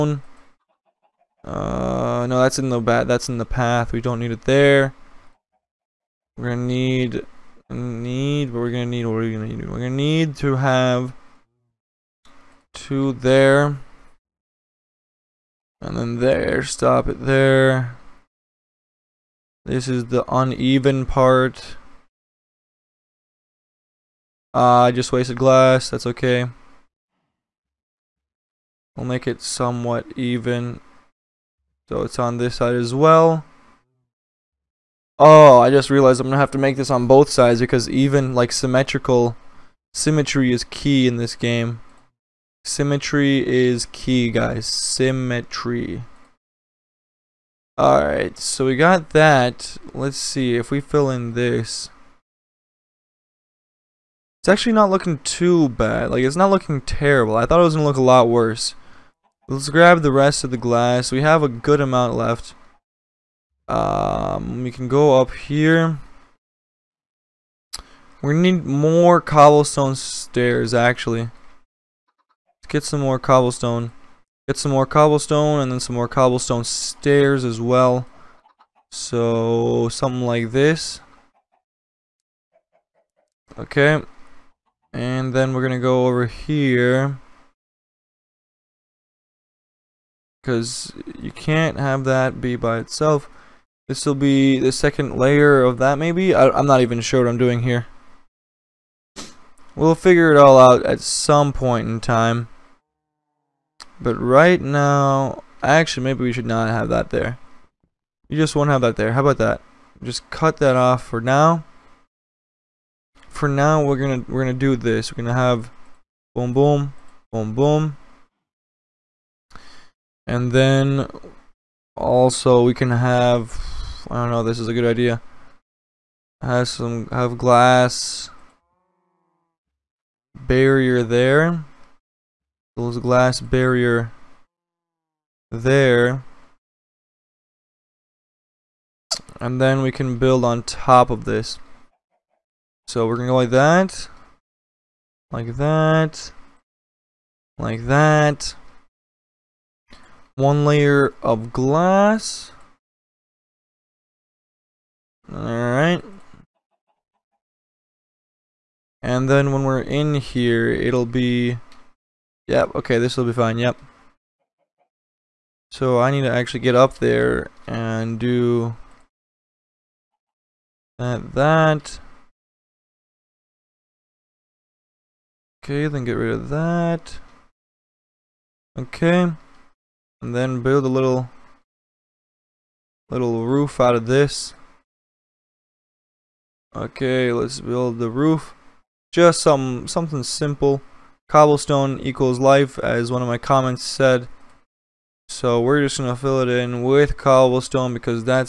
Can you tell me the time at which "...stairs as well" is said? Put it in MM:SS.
01:16.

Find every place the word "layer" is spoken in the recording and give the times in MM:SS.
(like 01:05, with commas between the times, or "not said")
01:35, 02:30.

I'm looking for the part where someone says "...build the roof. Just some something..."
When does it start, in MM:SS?
03:07.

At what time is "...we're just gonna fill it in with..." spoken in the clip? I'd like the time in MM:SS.
03:15.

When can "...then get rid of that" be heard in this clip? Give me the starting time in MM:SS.
02:55.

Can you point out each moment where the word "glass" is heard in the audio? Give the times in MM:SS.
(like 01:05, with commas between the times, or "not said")
00:25, 01:00, 02:07, 02:12, 02:31.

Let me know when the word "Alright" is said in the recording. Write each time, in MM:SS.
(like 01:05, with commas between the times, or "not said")
00:47, 02:35.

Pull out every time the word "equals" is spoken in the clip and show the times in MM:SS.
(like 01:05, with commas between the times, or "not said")
03:11.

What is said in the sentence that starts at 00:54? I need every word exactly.
It's actually not looking too bad.